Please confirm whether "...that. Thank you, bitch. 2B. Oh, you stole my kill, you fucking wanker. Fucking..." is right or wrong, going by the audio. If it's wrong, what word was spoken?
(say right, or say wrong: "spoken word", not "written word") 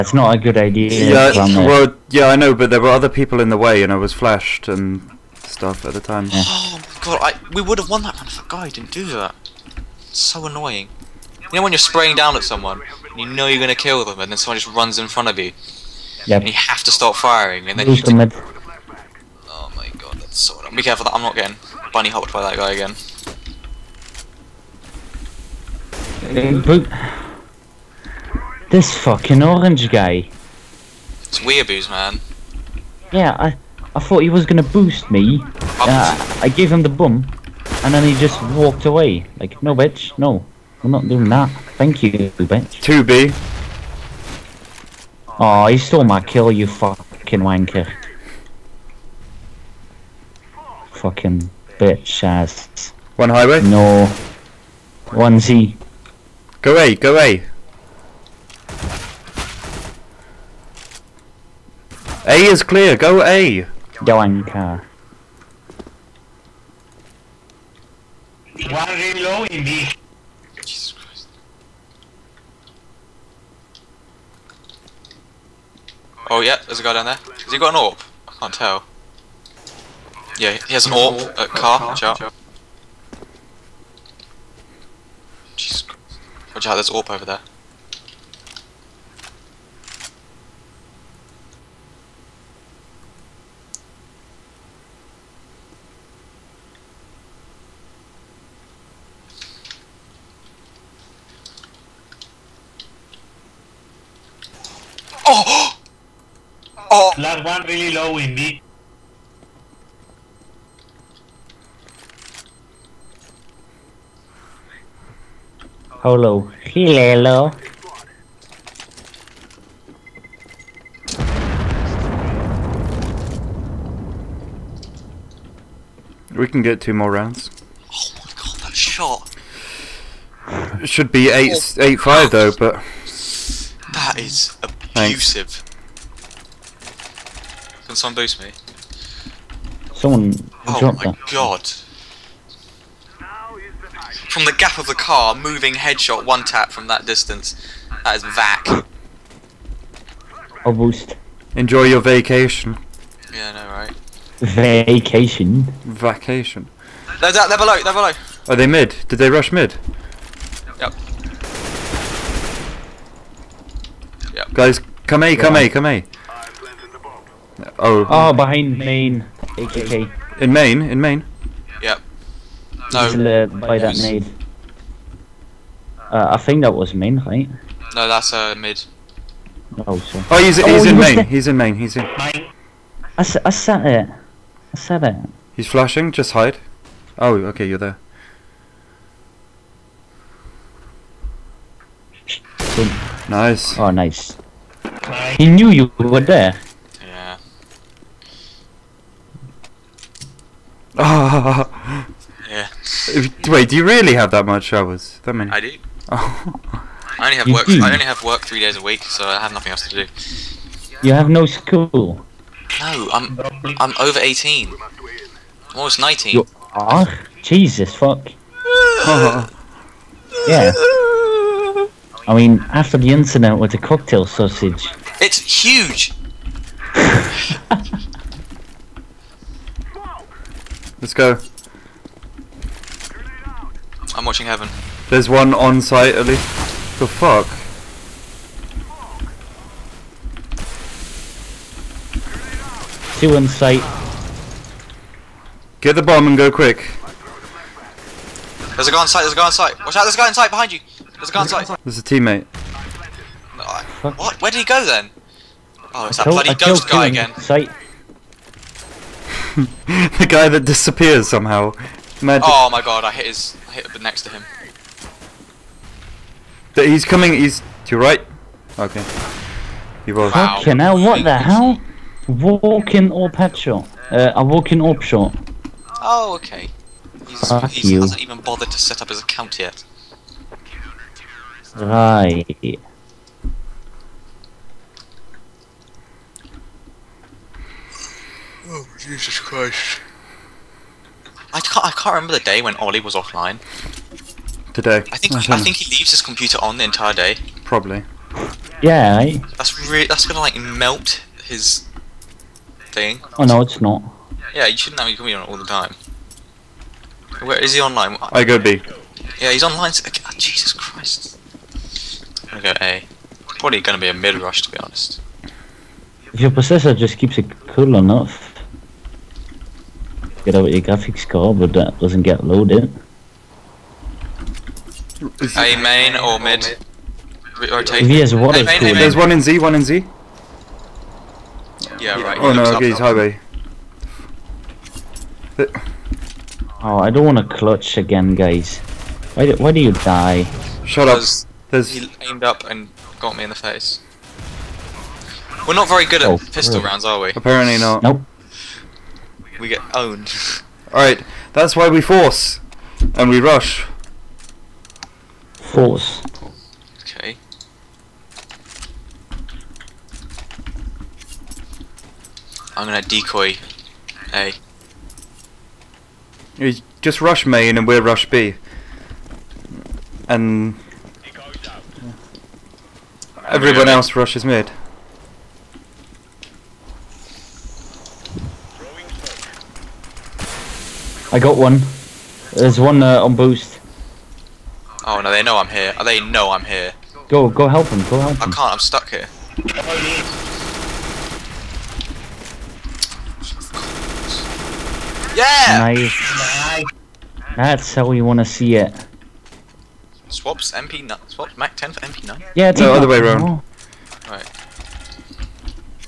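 right.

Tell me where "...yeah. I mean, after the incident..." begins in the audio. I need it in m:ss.
3:40.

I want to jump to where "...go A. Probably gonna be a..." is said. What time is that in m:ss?
5:12.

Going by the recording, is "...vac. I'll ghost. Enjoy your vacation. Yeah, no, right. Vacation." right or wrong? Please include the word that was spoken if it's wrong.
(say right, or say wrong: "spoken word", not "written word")
wrong: "boost", not "ghost".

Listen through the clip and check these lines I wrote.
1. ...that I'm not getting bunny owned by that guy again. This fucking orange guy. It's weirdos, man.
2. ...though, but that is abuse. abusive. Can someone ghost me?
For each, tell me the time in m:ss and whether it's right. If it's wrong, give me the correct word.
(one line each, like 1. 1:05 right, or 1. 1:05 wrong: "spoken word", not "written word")
1. 0:21 wrong: "hopped", not "owned"
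2. 2:12 wrong: "boost", not "ghost".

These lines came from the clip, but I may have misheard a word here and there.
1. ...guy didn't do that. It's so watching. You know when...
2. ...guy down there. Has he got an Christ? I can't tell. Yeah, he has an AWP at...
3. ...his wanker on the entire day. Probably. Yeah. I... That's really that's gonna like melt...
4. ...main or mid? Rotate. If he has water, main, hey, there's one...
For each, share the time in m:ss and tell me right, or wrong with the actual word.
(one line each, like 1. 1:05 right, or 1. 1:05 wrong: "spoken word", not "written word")
1. 0:08 wrong: "annoying", not "watching"
2. 1:16 wrong: "AWP", not "Christ"
3. 4:56 wrong: "computer", not "wanker"
4. 5:25 right.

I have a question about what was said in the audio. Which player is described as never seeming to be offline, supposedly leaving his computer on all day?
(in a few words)
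Ollie.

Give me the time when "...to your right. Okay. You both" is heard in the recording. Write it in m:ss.
4:27.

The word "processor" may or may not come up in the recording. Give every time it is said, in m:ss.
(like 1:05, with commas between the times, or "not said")
5:16.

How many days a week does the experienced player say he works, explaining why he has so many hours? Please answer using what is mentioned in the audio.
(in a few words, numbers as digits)
3.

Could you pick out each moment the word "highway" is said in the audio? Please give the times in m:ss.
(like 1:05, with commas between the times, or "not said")
0:53, 5:32.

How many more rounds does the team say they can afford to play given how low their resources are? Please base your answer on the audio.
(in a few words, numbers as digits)
2.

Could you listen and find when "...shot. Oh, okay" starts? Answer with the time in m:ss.
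4:35.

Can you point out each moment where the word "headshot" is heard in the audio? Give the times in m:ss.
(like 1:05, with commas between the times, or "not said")
2:25, 4:33.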